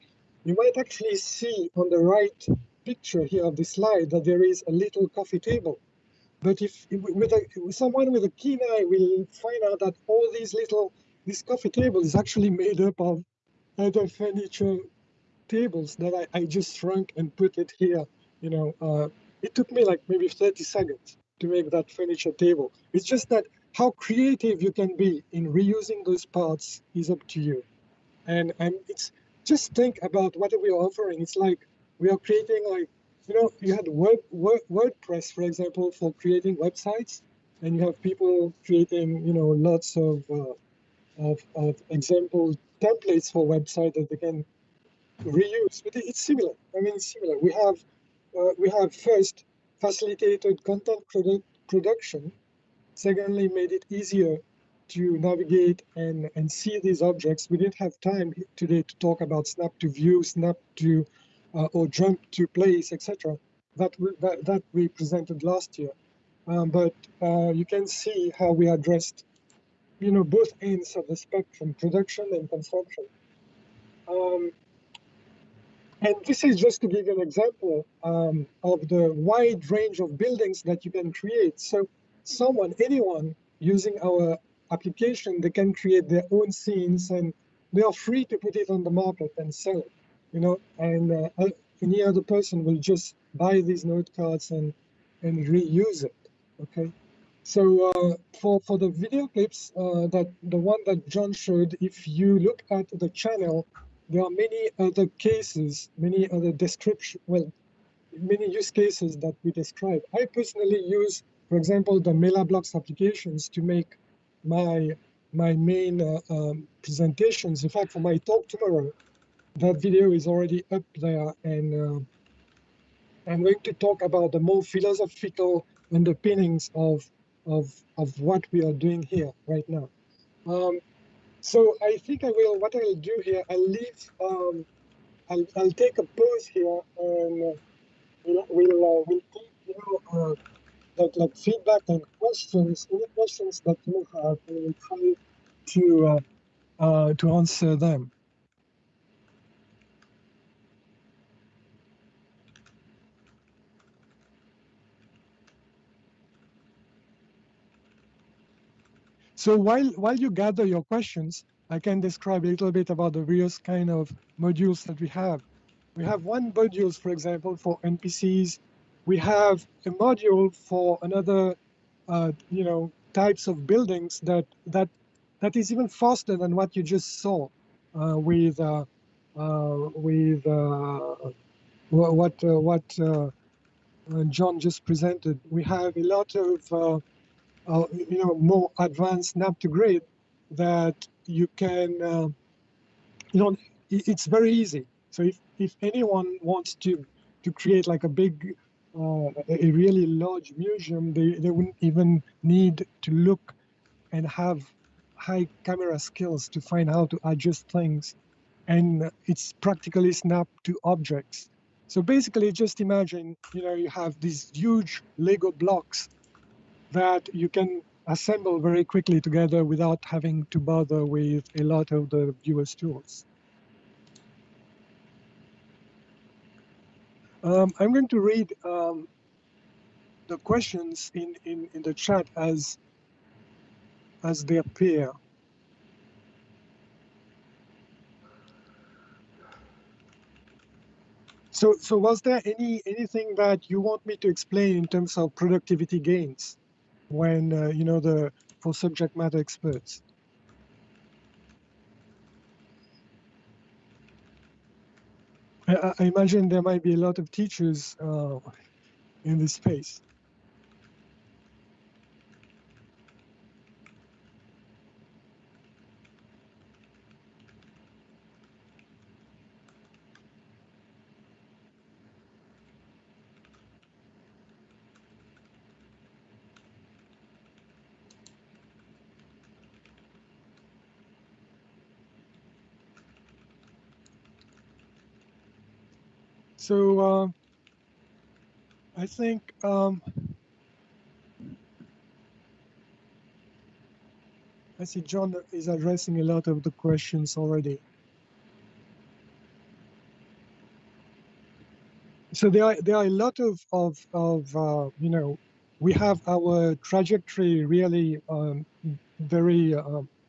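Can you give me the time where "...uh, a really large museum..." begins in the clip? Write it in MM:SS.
03:18.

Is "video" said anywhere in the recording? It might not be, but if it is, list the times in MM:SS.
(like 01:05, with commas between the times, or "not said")
01:38, 01:59.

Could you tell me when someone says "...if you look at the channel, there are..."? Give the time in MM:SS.
01:41.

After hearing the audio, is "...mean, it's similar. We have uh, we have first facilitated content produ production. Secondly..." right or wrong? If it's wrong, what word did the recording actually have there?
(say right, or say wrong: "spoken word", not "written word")
right.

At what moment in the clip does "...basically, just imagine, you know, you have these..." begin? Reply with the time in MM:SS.
03:32.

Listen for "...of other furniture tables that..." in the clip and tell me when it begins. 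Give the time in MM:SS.
00:13.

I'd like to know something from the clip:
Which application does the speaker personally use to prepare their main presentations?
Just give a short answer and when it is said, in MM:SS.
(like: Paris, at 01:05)
MailerBlocks, at 01:52.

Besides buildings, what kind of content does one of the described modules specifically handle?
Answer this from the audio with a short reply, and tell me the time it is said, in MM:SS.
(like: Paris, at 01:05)
NPCs, at 02:47.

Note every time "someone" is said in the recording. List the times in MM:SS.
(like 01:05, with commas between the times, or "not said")
00:07, 01:22.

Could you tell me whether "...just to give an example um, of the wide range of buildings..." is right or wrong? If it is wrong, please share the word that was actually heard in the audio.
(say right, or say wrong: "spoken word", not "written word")
right.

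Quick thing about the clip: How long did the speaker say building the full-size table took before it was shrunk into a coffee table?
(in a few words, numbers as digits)
30 seconds.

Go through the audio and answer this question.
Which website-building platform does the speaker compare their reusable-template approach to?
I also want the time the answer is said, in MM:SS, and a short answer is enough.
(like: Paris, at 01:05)
WordPress, at 00:33.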